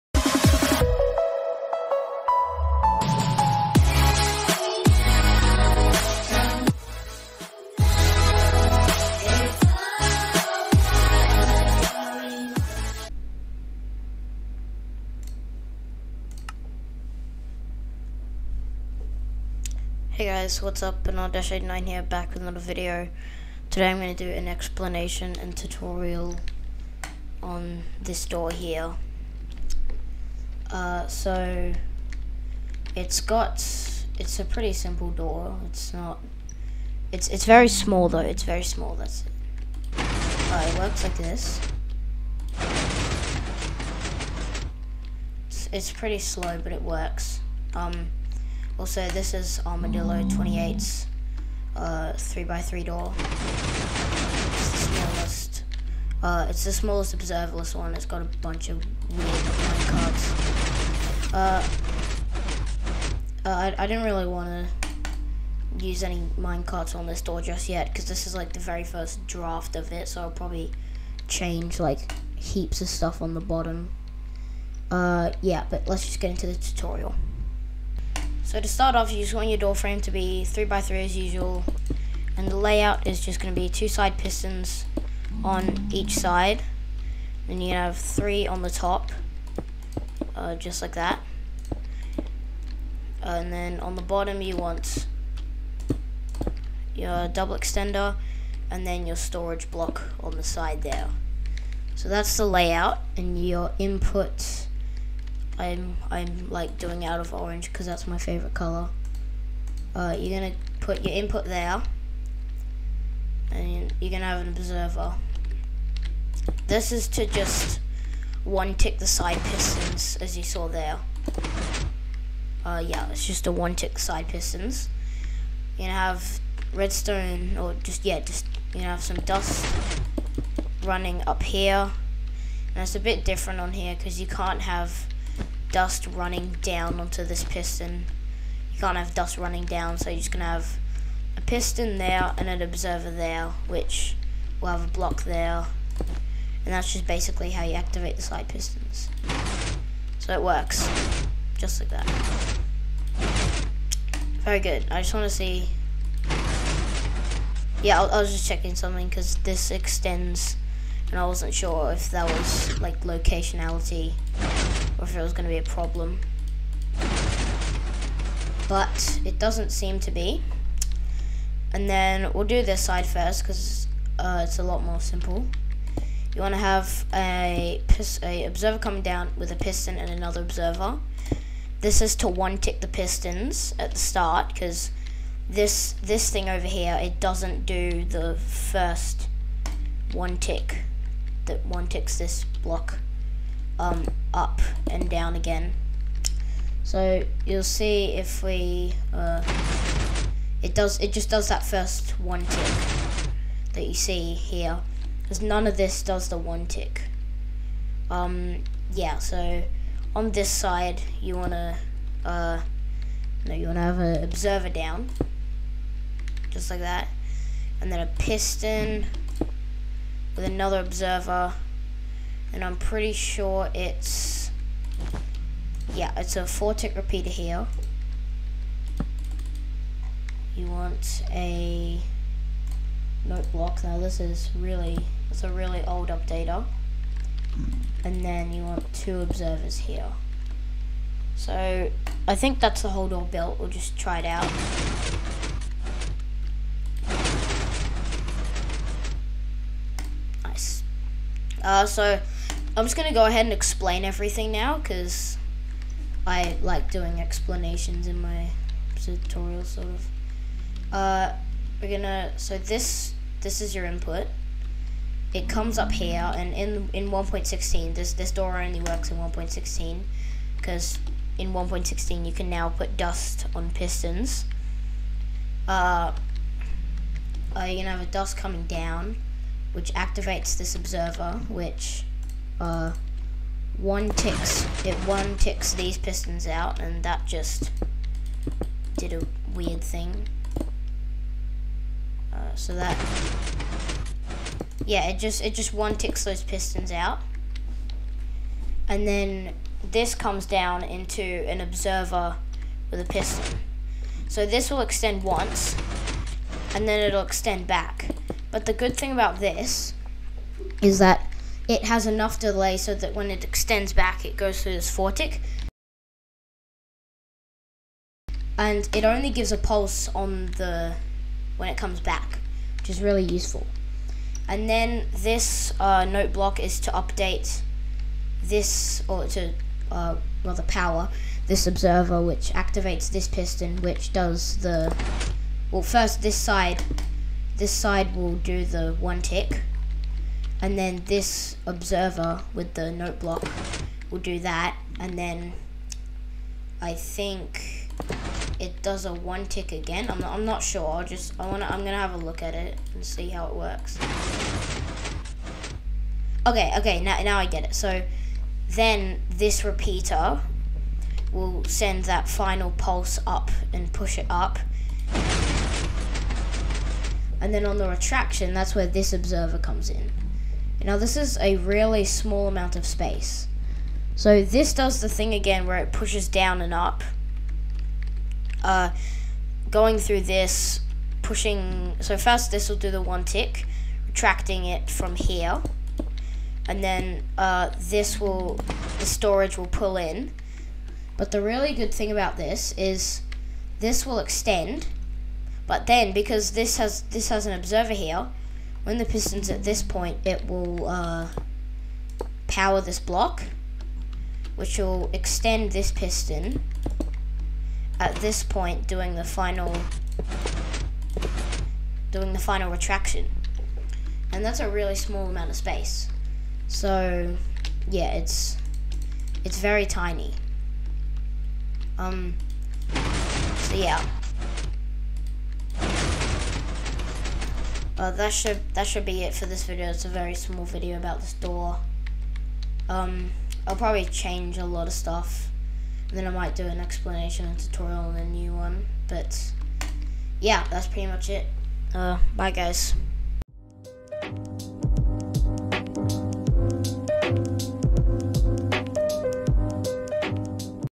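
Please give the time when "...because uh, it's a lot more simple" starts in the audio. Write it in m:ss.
2:53.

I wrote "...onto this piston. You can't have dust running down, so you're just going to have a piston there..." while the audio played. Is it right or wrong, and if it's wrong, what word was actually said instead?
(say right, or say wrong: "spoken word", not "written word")
right.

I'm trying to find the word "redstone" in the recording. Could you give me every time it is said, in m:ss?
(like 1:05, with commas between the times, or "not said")
2:06.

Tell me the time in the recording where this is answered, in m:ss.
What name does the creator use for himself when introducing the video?
0:21.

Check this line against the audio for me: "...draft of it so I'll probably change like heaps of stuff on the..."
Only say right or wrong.
right.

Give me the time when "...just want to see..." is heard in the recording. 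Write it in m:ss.
2:35.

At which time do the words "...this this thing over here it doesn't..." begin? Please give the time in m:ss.
3:05.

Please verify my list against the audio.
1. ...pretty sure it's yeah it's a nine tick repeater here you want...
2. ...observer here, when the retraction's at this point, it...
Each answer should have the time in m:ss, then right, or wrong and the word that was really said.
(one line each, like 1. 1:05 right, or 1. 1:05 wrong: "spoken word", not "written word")
1. 3:42 wrong: "four", not "nine"
2. 6:37 wrong: "piston", not "retraction".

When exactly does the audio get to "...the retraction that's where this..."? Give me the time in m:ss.
6:07.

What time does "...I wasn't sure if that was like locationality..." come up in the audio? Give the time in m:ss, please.
2:41.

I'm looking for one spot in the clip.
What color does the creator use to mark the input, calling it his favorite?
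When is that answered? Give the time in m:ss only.
1:47.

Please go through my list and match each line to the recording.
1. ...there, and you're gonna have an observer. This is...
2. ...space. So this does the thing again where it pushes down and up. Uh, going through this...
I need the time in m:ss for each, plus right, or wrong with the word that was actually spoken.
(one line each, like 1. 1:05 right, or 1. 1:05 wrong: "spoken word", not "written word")
1. 1:51 right
2. 6:12 right.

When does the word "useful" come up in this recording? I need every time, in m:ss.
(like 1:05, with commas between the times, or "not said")
5:23.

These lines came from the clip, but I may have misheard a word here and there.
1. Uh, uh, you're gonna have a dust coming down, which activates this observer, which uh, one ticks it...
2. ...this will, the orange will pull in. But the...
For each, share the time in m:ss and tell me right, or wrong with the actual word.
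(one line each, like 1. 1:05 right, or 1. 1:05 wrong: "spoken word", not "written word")
1. 4:35 right
2. 6:27 wrong: "storage", not "orange".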